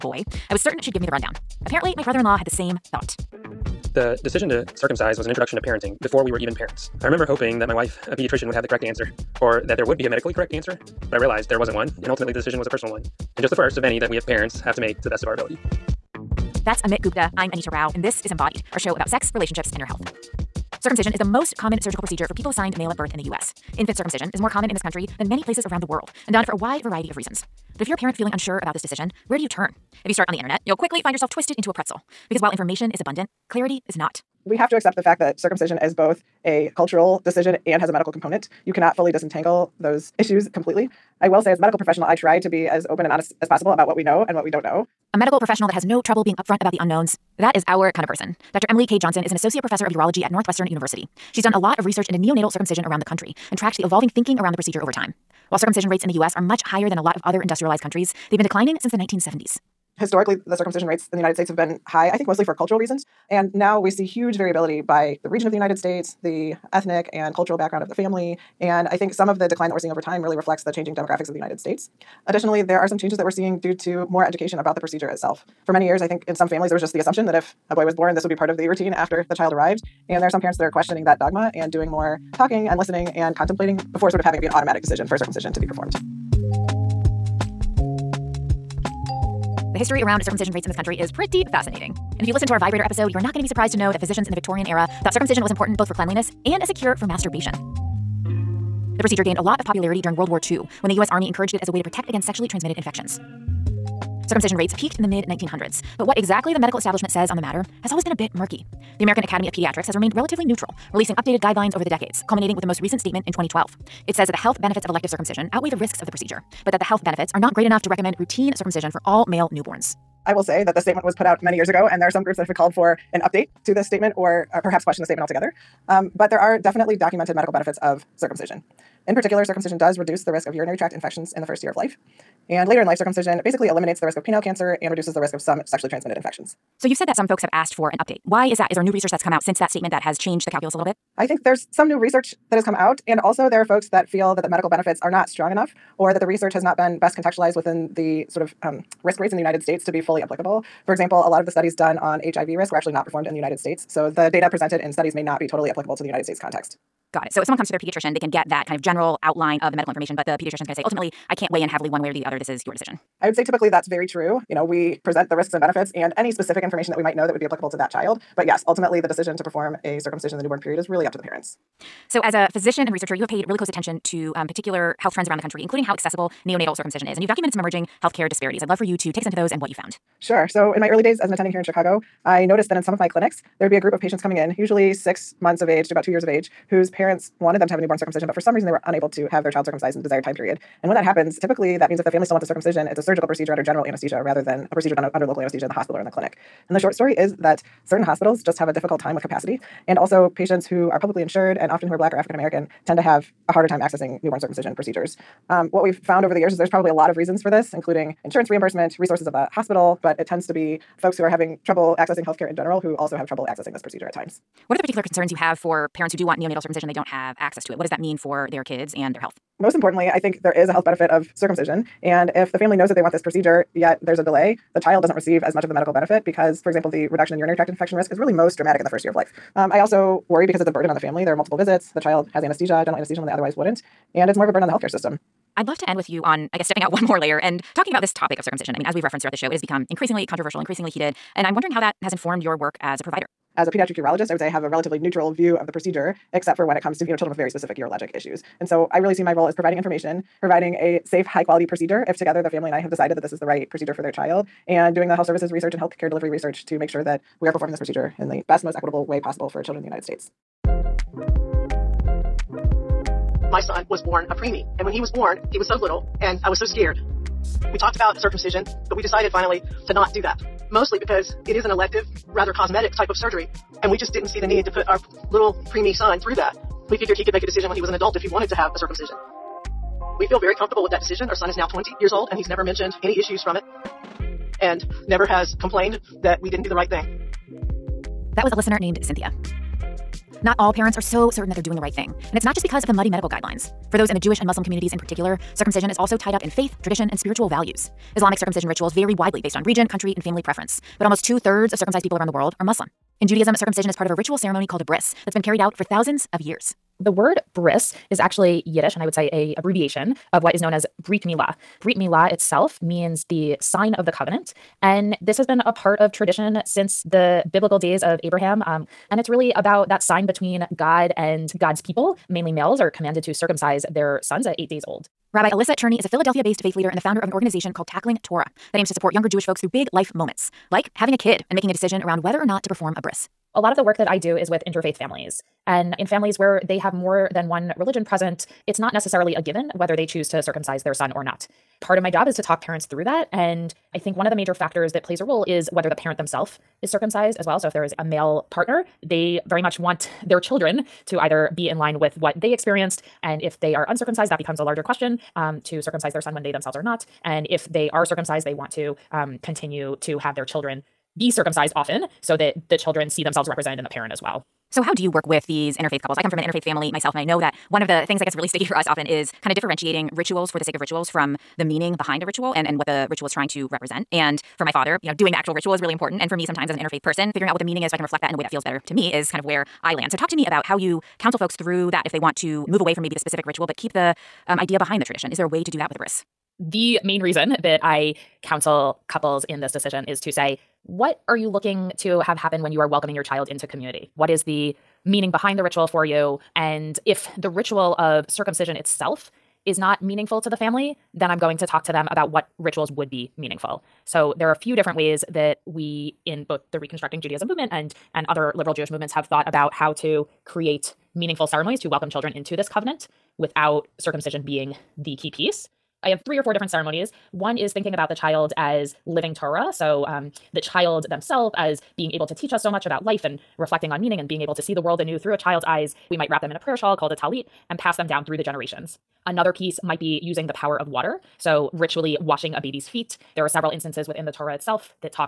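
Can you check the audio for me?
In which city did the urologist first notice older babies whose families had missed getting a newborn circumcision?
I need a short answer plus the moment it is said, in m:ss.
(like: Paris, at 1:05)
Chicago, at 3:01.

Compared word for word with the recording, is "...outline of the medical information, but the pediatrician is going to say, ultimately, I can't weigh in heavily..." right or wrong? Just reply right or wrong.
right.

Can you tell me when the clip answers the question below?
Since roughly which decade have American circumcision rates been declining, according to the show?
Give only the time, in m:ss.
0:58.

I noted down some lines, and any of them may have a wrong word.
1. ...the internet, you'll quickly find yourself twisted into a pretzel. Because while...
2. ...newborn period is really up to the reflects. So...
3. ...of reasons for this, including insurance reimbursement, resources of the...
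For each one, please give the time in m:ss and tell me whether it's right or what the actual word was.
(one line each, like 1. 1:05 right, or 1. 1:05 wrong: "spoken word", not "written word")
1. 0:30 right
2. 2:50 wrong: "parents", not "reflects"
3. 3:27 right.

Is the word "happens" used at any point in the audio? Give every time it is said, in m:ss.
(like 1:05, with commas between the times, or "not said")
3:11, 6:32.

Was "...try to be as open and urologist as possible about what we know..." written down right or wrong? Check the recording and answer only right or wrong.
wrong.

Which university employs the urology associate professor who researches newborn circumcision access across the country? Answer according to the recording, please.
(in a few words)
Northwestern University.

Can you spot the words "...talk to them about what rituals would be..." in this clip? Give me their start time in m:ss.
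6:41.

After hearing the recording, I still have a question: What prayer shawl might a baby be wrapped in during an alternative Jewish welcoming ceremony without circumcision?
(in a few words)
talit.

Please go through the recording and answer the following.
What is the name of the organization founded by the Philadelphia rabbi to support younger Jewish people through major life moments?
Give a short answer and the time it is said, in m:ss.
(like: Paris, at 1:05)
Tackling Torah, at 5:27.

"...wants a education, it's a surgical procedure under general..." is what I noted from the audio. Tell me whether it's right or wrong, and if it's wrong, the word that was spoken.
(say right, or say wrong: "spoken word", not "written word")
wrong: "circumcision", not "education".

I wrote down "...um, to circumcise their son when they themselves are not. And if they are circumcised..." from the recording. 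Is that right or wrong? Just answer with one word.
right.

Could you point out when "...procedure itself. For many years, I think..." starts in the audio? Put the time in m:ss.
1:14.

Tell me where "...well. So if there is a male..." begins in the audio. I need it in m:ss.
5:47.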